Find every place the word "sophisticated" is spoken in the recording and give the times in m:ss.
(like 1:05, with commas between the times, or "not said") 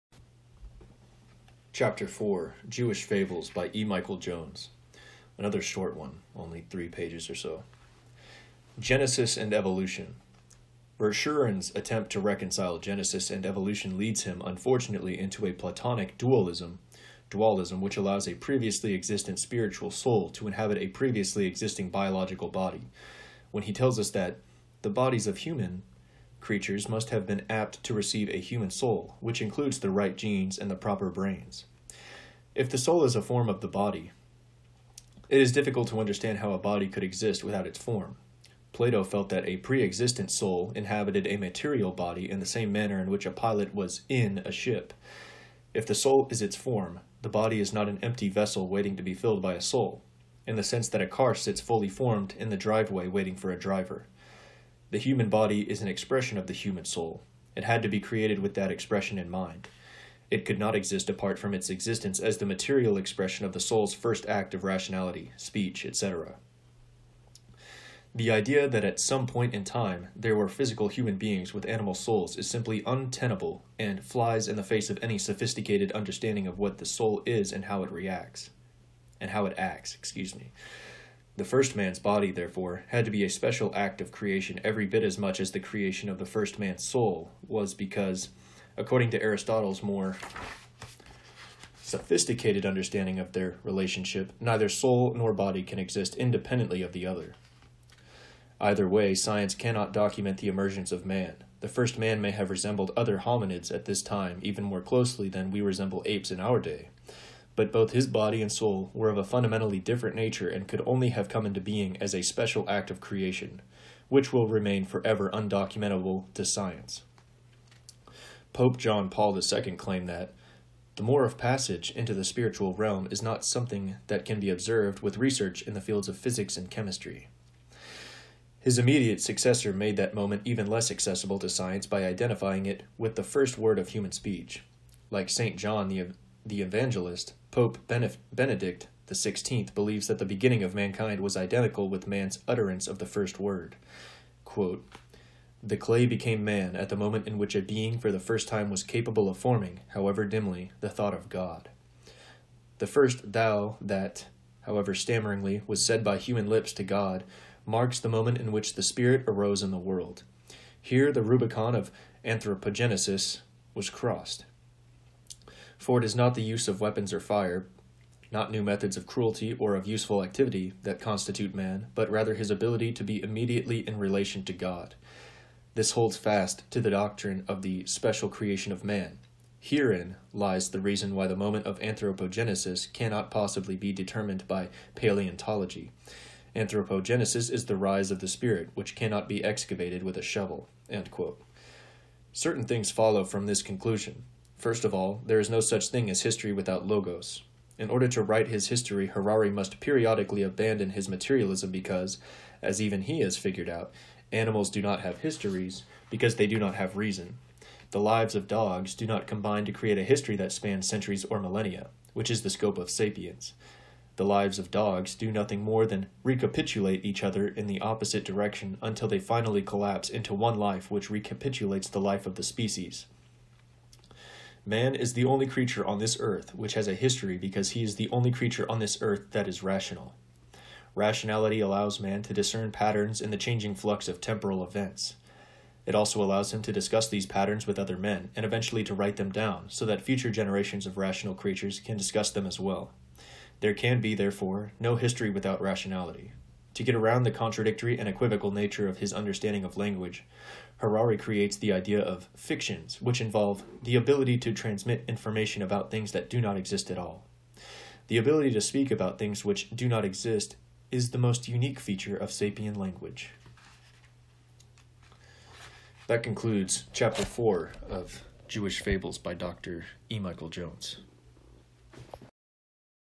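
1:15, 1:31.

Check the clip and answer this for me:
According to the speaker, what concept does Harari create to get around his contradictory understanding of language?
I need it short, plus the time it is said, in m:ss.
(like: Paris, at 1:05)
fictions, at 4:12.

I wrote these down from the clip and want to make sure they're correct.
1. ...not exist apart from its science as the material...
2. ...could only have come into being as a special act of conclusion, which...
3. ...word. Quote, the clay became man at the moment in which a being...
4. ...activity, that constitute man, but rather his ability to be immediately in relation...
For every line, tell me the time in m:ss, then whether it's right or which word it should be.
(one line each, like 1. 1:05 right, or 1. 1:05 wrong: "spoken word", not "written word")
1. 1:00 wrong: "existence", not "science"
2. 1:50 wrong: "creation", not "conclusion"
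3. 2:23 right
4. 2:50 right.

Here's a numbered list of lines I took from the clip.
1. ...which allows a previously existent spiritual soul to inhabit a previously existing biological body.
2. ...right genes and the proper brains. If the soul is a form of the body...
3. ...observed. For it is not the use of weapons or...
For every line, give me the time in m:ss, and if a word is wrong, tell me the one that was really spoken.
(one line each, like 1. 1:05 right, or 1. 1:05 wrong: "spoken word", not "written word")
1. 0:17 right
2. 0:29 right
3. 2:43 wrong: "crossed", not "observed".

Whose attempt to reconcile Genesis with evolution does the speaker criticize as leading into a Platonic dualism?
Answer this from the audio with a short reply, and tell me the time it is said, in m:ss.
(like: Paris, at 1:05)
Verschuuren, at 0:10.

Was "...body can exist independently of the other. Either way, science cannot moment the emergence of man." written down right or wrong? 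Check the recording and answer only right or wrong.
wrong.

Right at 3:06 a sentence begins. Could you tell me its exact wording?
Anthropogenesis is the rise of the spirit, which cannot be excavated with a shovel.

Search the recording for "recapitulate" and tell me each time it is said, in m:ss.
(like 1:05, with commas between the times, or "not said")
3:36, 3:41.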